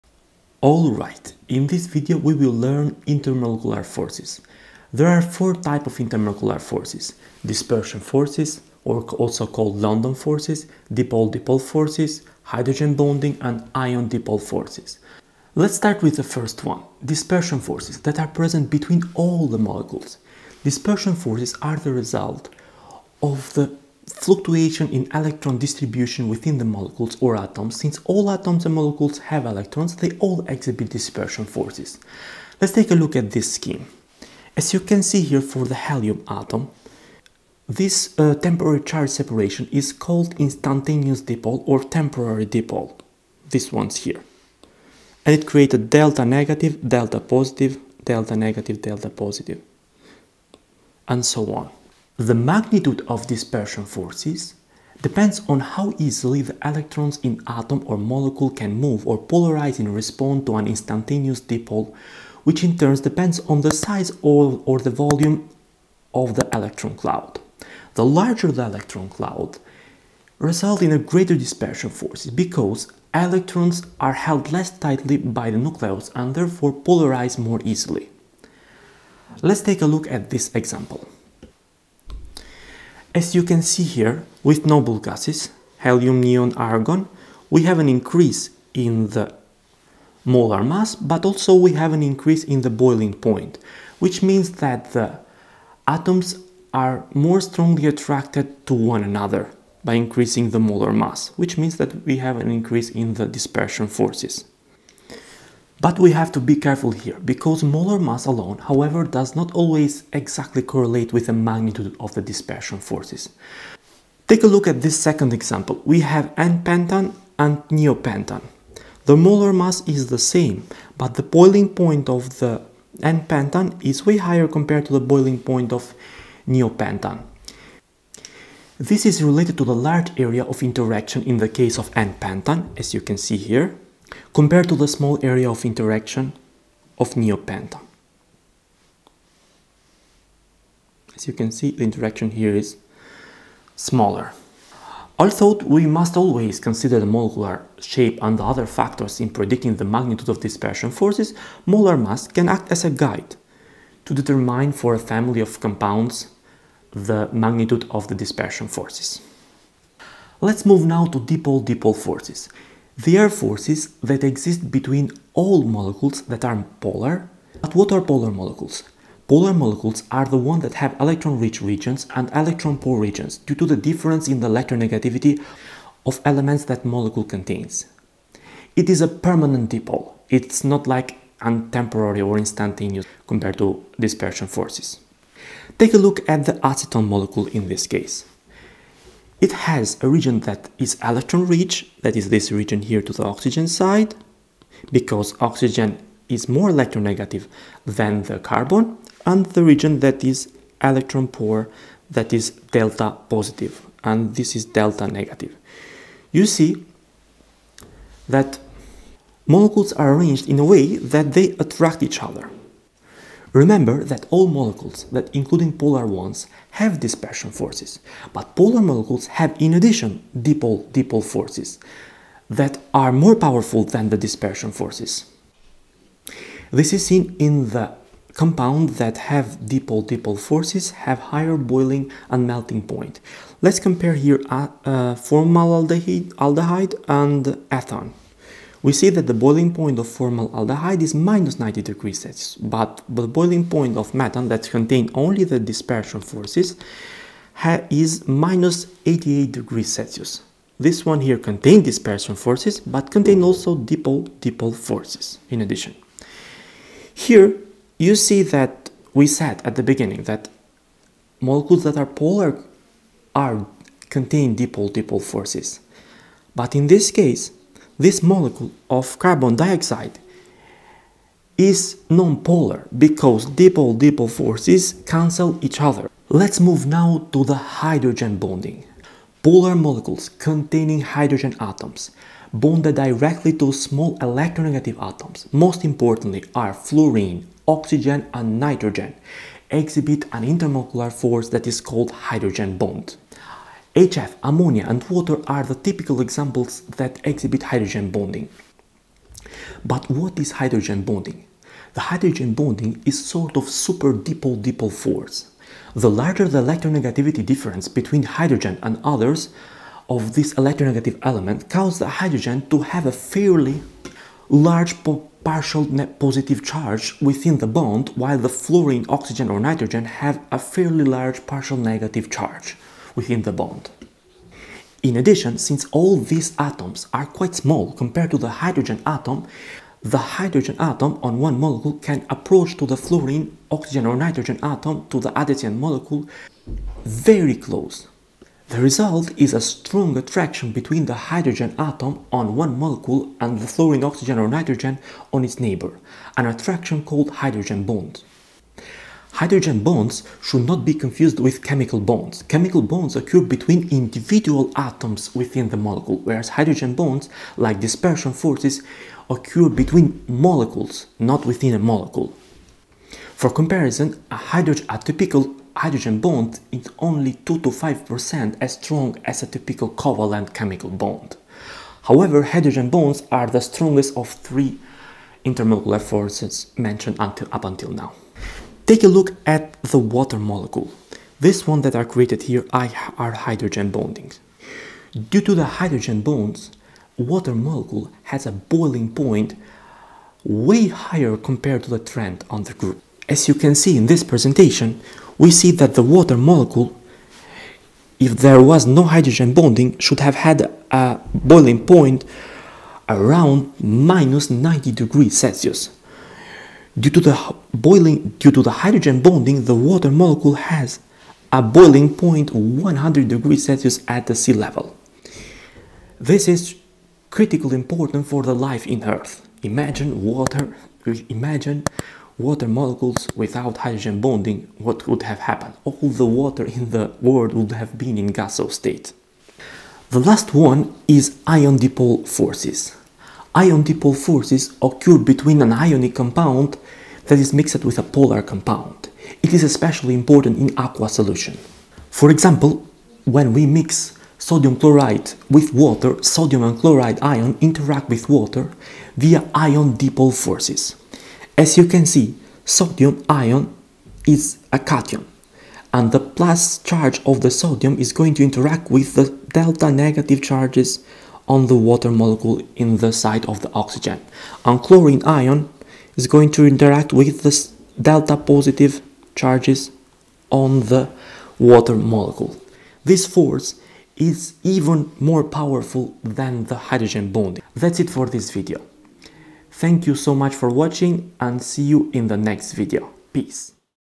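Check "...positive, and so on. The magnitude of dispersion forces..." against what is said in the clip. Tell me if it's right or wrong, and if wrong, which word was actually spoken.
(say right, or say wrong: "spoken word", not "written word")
right.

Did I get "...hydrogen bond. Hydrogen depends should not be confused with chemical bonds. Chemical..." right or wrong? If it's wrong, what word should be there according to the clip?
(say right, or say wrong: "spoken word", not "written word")
wrong: "bonds", not "depends".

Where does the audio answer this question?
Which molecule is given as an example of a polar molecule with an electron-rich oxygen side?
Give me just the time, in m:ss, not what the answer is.
3:06.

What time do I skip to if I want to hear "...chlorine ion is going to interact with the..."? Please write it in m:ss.
7:44.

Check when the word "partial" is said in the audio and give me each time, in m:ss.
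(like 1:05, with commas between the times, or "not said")
5:15, 5:21.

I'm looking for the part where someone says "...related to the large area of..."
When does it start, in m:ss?
2:09.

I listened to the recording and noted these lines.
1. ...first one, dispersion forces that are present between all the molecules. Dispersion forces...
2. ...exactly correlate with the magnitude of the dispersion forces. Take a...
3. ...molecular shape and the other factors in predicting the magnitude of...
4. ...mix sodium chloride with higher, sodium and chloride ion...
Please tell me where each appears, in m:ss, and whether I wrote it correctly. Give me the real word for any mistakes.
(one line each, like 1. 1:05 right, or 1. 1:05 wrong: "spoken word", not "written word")
1. 0:16 right
2. 1:50 right
3. 2:27 right
4. 7:23 wrong: "water", not "higher".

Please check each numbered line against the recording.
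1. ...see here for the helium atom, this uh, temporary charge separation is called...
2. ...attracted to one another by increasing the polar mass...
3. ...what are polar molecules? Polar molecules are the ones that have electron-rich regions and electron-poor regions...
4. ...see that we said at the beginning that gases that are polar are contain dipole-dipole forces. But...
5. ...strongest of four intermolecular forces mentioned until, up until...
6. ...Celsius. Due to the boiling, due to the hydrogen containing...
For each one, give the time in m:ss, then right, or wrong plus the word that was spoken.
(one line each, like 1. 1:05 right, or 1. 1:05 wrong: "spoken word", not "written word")
1. 0:35 right
2. 1:37 wrong: "molar", not "polar"
3. 2:47 right
4. 4:18 wrong: "molecules", not "gases"
5. 6:13 wrong: "three", not "four"
6. 6:45 wrong: "bonding", not "containing".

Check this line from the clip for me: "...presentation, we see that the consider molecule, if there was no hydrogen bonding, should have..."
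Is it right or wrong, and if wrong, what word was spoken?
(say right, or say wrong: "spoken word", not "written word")
wrong: "water", not "consider".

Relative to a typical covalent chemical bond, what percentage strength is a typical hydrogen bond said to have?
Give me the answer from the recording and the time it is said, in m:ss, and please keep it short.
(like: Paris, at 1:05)
2 to 5%, at 6:07.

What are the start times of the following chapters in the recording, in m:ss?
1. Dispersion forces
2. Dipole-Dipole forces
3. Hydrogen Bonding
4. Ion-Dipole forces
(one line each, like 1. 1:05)
1. 0:15
2. 2:40
3. 4:37
4. 7:10.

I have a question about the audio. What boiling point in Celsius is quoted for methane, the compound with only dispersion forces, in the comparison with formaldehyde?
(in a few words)
-88.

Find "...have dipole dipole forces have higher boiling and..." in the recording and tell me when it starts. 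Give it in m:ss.
3:49.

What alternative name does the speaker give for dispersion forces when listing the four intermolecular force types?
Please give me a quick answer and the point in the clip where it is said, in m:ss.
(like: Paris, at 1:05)
London forces, at 0:09.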